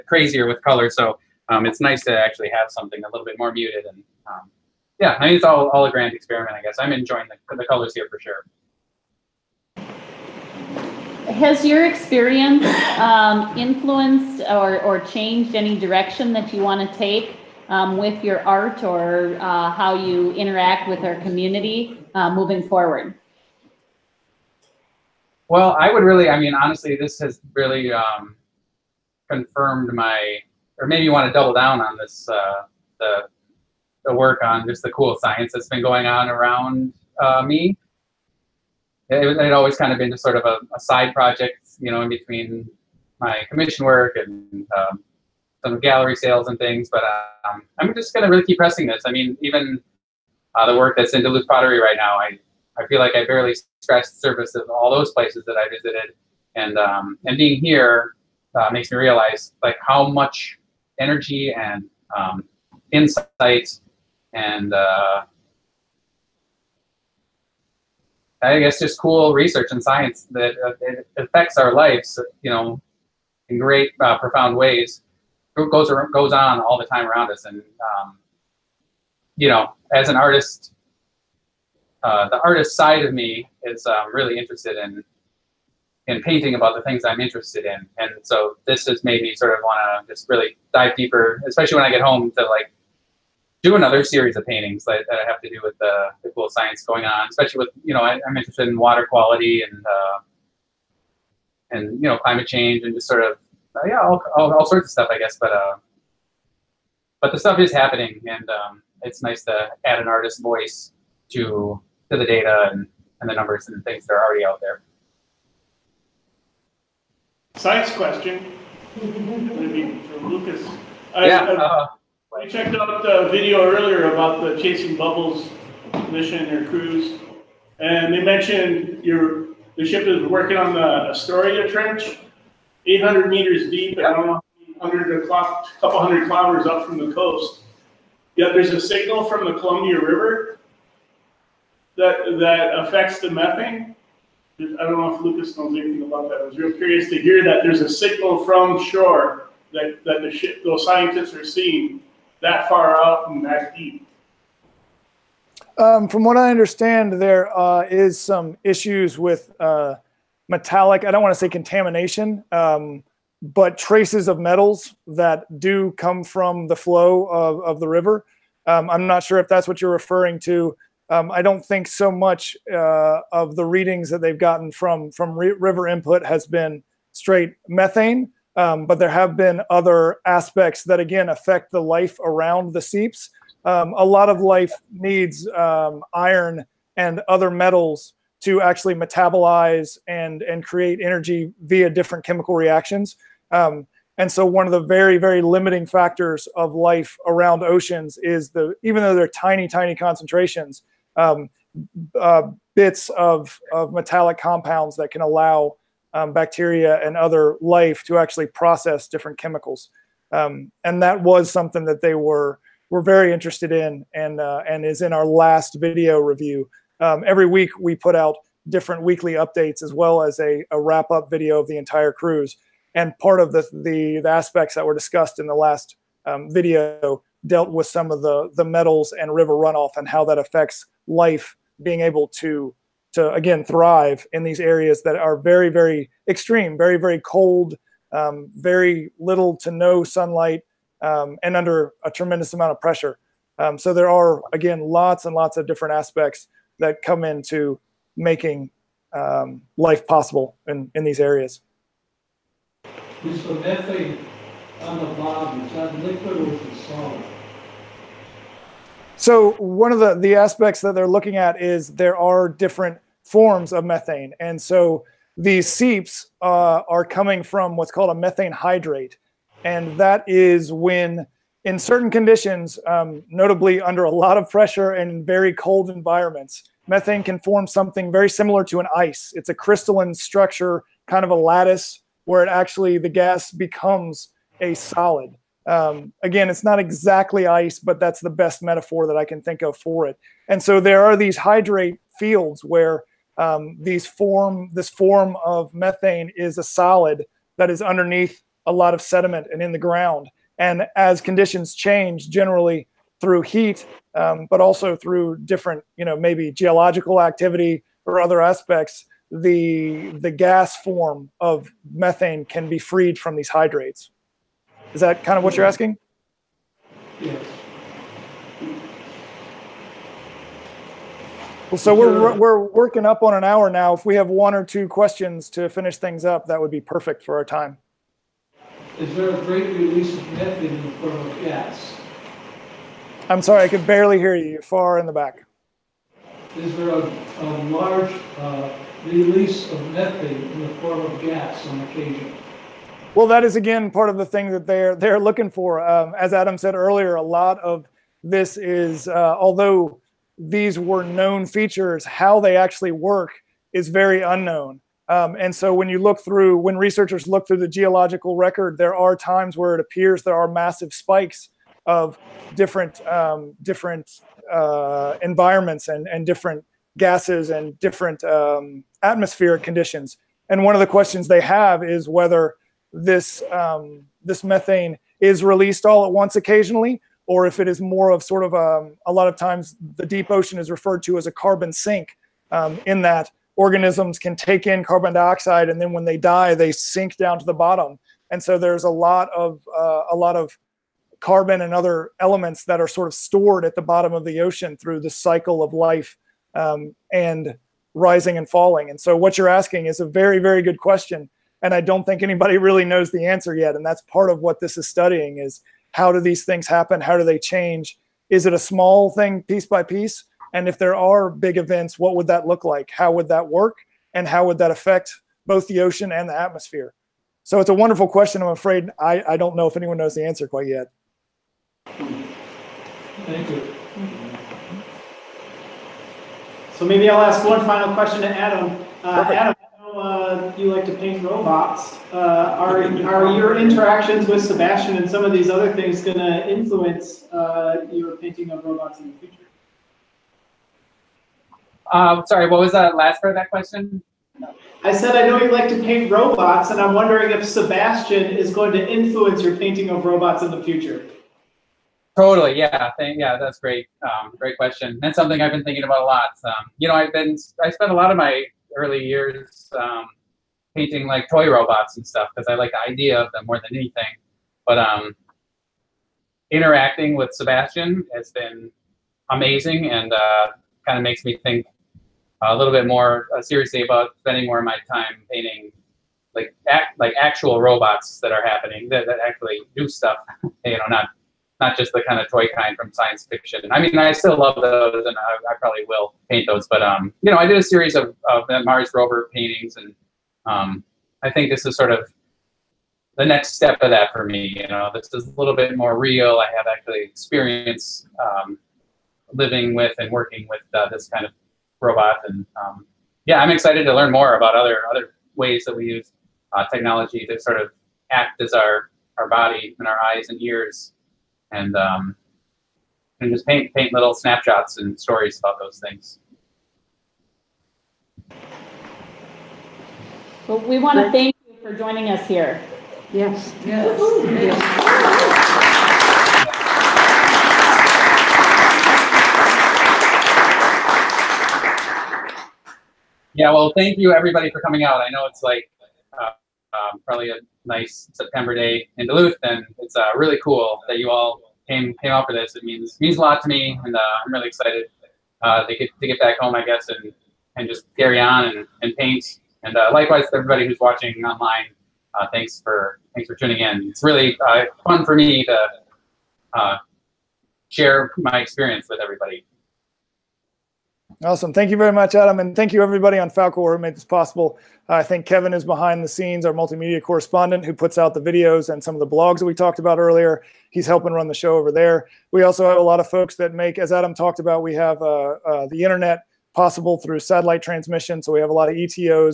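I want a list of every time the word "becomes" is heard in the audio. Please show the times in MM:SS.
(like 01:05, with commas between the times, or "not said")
04:43.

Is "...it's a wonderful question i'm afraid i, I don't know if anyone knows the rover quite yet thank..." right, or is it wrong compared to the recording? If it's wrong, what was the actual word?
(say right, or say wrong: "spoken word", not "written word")
wrong: "answer", not "rover".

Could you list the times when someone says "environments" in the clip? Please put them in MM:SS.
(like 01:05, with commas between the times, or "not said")
04:35, 06:05.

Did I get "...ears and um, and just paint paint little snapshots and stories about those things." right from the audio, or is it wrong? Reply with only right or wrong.
right.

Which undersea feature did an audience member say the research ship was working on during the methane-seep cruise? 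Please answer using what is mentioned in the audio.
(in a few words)
Astoria Trench.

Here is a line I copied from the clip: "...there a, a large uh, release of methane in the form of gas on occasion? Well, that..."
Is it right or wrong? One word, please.
right.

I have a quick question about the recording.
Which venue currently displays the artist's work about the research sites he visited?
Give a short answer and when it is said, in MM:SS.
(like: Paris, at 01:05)
Duluth Pottery, at 00:51.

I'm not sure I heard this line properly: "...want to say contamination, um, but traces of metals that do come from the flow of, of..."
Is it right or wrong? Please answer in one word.
right.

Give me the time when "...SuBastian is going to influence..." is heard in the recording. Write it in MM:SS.
07:27.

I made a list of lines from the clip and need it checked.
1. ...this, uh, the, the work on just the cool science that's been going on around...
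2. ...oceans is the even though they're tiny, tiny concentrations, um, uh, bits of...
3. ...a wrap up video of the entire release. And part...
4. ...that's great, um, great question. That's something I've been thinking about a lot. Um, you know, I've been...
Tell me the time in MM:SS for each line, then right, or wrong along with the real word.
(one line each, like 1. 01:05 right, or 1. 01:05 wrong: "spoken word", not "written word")
1. 00:31 right
2. 03:17 right
3. 03:40 wrong: "cruise", not "release"
4. 07:33 right.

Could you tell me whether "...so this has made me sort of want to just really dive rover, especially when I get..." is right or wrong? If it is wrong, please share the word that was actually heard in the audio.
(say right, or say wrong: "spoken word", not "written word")
wrong: "deeper", not "rover".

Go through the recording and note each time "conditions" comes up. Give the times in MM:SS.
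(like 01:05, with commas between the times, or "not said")
04:32, 05:01, 06:09.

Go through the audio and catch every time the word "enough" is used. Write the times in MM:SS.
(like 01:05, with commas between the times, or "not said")
not said.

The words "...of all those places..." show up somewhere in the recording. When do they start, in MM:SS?
00:54.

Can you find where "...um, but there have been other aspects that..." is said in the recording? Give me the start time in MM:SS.
02:58.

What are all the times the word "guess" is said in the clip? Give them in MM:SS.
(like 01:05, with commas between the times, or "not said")
00:06, 01:08, 01:45, 09:06.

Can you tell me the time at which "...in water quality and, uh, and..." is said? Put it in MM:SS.
01:38.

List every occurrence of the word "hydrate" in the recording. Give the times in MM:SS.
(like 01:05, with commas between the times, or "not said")
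04:28, 04:51, 05:13.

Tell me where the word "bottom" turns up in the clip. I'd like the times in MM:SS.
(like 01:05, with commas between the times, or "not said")
04:15, 06:27, 06:33.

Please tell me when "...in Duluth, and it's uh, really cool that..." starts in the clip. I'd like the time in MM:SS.
08:58.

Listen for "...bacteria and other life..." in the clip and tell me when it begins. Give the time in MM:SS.
03:26.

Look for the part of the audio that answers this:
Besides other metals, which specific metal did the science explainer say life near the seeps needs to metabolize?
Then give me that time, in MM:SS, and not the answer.
03:06.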